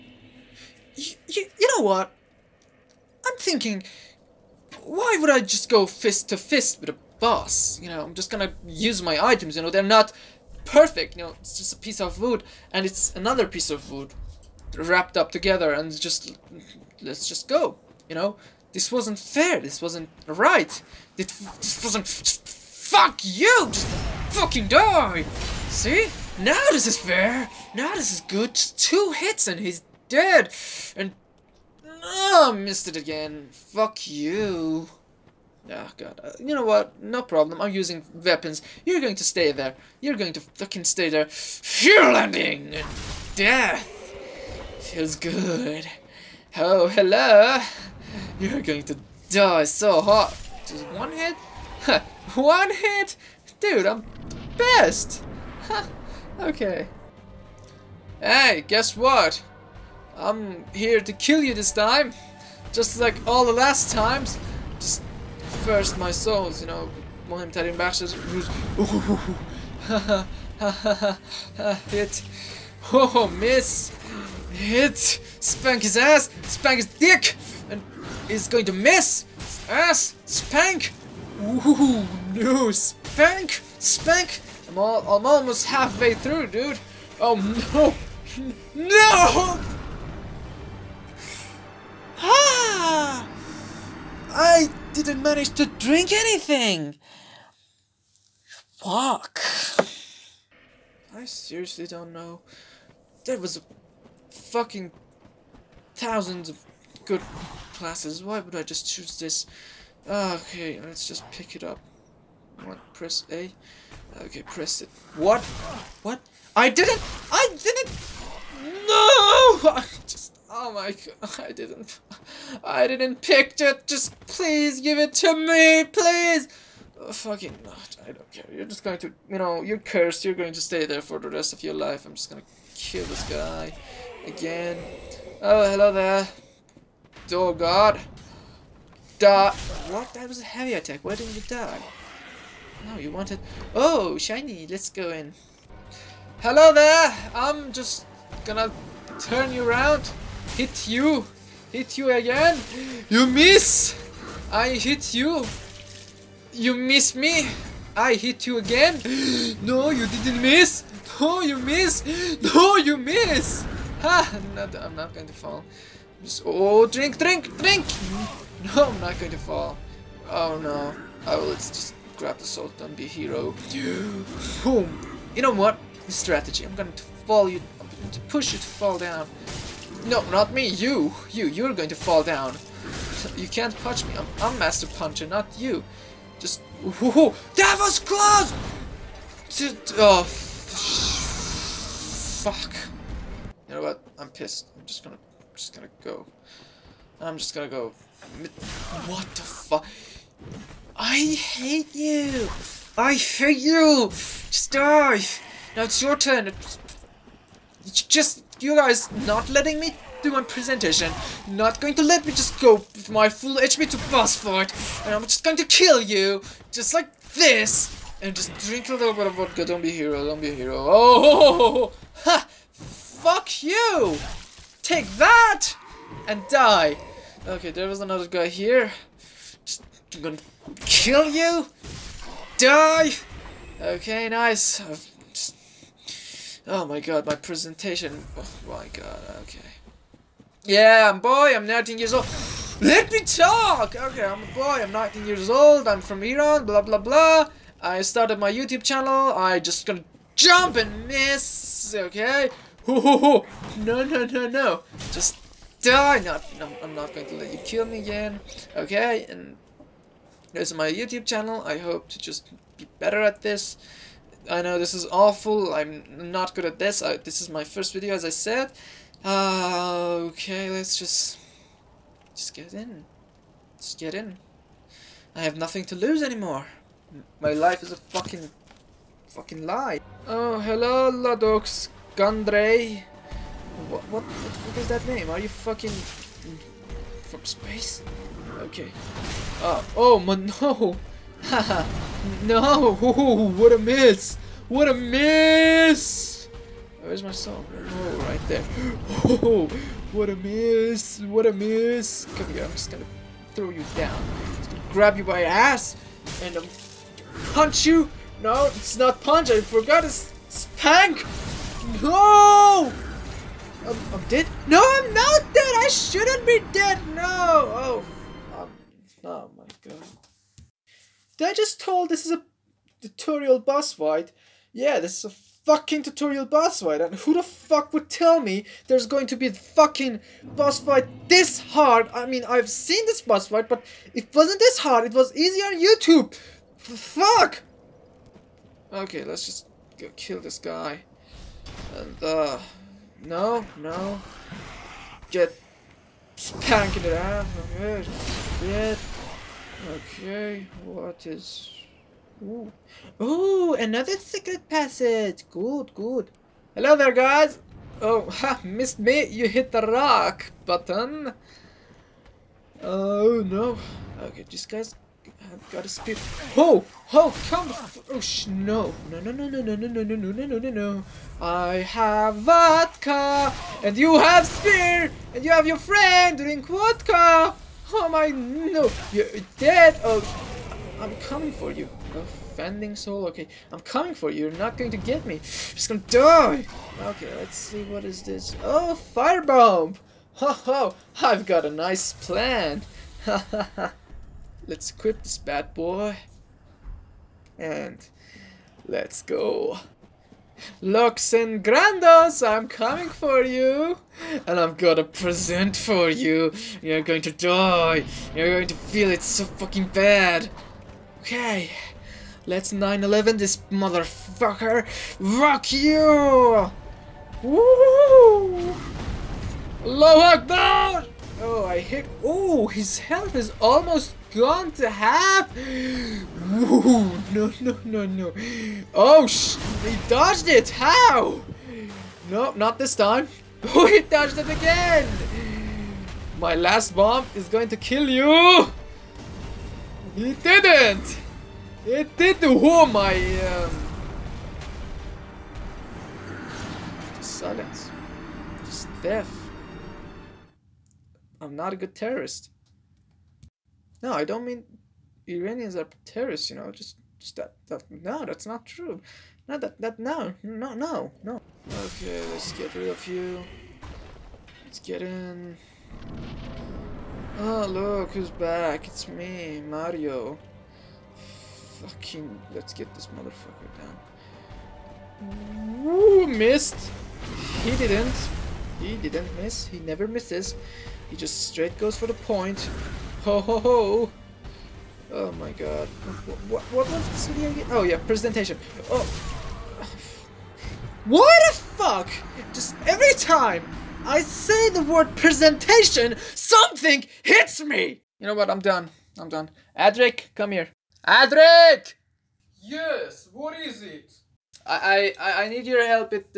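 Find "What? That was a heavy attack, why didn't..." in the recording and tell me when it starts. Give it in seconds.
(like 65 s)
139 s.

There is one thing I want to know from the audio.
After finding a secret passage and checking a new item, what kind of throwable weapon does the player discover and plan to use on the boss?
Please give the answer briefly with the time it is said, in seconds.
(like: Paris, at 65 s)
Firebomb, at 389 s.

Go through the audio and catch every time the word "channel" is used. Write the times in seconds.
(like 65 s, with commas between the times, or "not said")
248 s, 261 s.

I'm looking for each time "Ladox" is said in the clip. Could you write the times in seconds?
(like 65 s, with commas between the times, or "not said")
281 s.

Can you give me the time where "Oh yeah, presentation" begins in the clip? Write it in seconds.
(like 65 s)
487 s.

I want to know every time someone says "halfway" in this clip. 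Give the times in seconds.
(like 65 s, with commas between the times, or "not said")
85 s.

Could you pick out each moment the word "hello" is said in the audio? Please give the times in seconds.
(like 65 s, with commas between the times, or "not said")
46 s, 135 s, 146 s, 280 s, 356 s.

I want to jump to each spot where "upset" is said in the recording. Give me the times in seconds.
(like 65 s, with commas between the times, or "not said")
not said.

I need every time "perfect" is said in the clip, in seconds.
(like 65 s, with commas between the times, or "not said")
10 s.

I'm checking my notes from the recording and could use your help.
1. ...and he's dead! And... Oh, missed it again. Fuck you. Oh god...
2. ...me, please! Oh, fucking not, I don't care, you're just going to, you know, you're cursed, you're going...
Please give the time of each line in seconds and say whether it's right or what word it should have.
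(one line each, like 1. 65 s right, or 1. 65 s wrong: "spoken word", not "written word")
1. 29 s right
2. 125 s right.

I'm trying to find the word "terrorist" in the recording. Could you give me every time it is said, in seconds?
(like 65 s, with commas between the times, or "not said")
451 s, 456 s.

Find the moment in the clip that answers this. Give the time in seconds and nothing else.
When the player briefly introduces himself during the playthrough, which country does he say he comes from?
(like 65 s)
246 s.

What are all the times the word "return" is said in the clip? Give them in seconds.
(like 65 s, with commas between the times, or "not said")
not said.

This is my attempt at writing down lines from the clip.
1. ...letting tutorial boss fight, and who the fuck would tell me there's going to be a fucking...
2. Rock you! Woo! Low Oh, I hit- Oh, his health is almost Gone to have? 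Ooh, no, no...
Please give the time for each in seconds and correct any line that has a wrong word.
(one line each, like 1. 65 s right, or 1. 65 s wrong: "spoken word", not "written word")
1. 325 s wrong: "fucking", not "letting"
2. 415 s right.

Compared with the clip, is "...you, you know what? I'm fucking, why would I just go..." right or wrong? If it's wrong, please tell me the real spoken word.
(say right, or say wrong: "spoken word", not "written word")
wrong: "thinking", not "fucking".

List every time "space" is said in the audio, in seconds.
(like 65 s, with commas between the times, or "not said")
287 s.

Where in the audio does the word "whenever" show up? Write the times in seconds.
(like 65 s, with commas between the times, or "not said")
not said.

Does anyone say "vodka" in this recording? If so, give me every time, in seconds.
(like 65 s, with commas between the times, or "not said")
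219 s, 372 s, 376 s.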